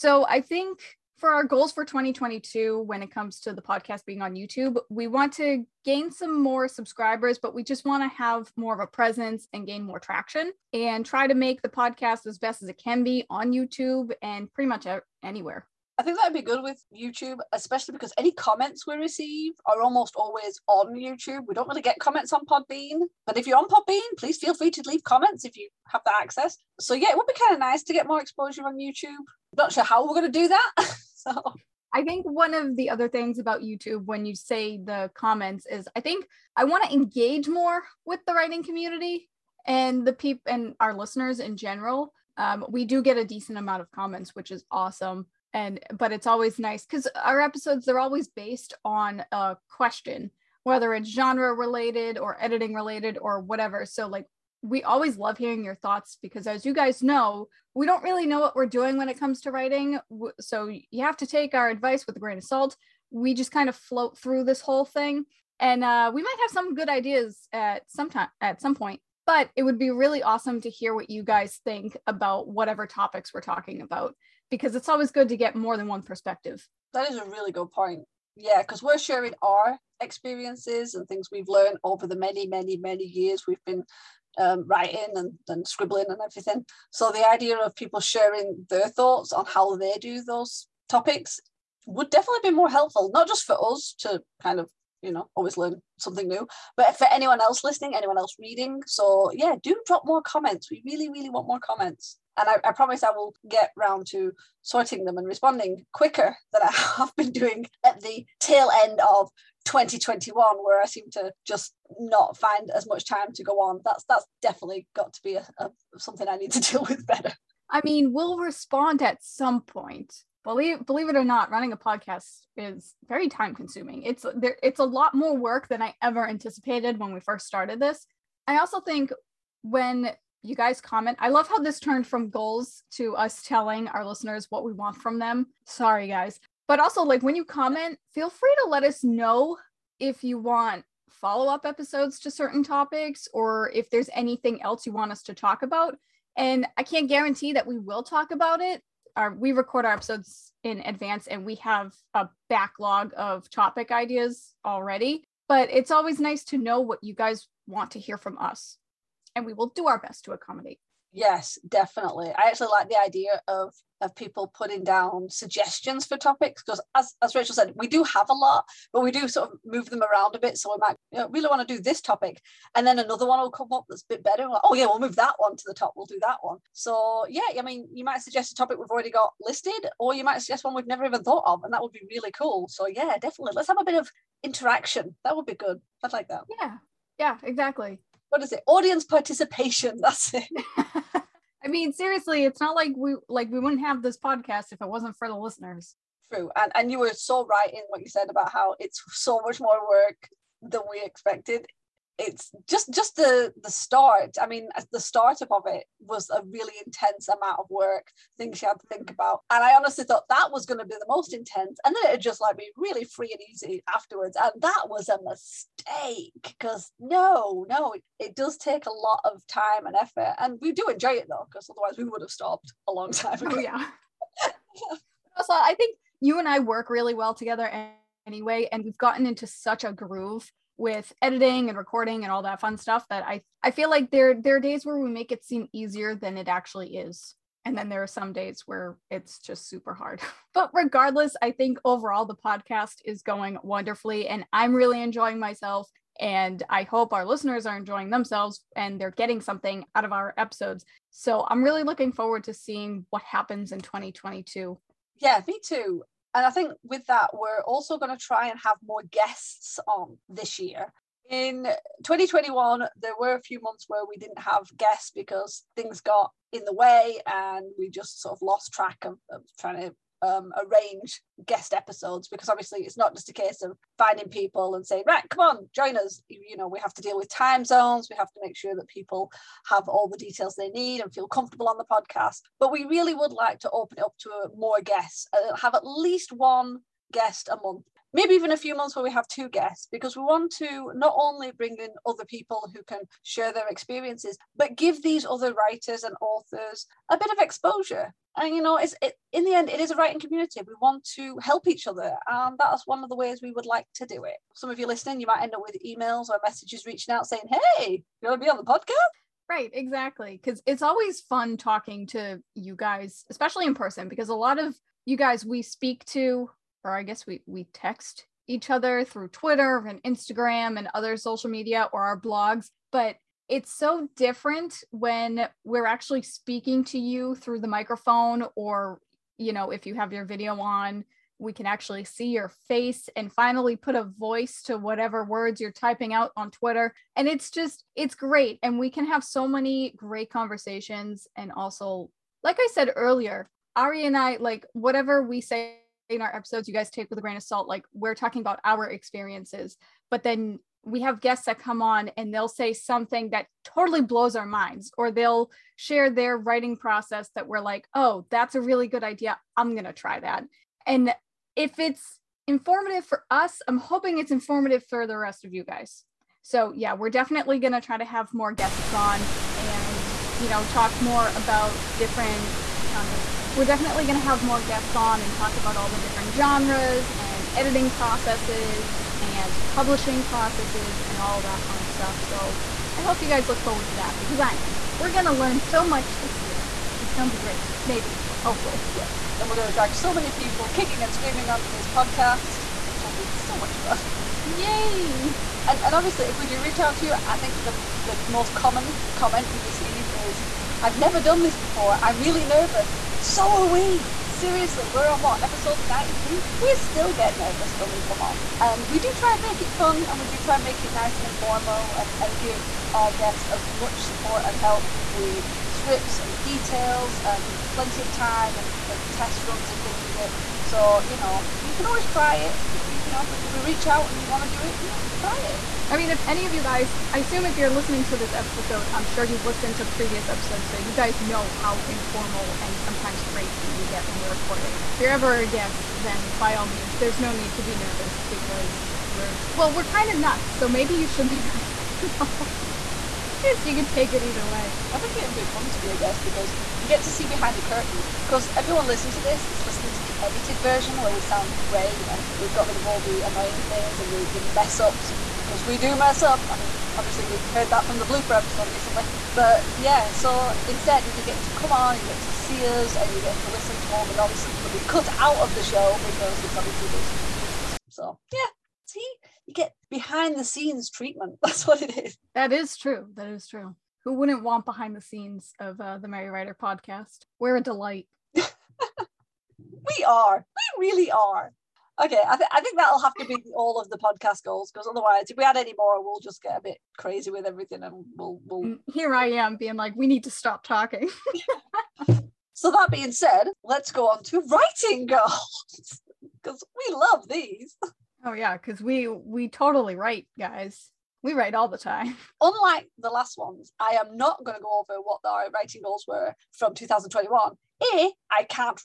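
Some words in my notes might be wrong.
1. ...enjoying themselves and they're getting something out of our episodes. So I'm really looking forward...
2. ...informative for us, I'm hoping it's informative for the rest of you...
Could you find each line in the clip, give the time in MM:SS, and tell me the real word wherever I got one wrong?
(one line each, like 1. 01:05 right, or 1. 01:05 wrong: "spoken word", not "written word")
1. 04:07 right
2. 06:02 right.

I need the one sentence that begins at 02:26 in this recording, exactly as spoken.
And I can't guarantee that we will talk about it.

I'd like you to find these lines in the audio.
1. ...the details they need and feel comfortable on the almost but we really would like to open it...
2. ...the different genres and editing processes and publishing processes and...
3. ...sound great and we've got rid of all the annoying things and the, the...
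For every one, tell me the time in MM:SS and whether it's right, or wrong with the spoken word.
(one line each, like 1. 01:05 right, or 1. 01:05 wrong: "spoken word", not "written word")
1. 04:40 wrong: "podcast", not "almost"
2. 06:15 right
3. 07:31 right.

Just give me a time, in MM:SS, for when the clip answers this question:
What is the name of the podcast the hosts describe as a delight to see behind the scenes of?
07:55.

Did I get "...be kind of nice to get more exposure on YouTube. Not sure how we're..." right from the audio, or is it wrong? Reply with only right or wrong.
right.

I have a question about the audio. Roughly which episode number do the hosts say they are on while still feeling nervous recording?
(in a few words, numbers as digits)
93.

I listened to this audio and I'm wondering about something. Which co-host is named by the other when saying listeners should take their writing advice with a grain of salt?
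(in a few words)
Ari.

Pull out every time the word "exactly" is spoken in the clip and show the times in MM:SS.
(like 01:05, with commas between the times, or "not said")
03:07, 05:09.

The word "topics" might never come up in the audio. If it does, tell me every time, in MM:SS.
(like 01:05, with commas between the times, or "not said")
01:12, 01:30, 02:22, 02:33, 02:46, 02:51, 02:58.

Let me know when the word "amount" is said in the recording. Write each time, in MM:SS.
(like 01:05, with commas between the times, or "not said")
00:43, 03:27.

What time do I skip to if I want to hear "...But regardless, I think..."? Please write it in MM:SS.
04:00.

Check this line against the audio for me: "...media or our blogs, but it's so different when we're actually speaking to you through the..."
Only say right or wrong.
right.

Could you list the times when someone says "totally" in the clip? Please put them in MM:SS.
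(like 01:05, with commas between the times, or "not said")
05:53, 08:19.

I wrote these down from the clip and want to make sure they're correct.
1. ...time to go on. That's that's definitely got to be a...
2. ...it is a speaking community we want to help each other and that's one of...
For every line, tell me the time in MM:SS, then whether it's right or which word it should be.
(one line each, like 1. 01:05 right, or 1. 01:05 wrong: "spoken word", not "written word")
1. 01:53 right
2. 04:59 wrong: "writing", not "speaking".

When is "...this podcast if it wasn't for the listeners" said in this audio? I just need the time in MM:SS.
03:14.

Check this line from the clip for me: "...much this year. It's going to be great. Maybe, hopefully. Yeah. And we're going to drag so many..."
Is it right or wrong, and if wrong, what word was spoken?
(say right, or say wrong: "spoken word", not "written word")
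right.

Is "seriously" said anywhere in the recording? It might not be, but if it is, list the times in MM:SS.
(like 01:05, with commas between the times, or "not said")
03:11, 06:44.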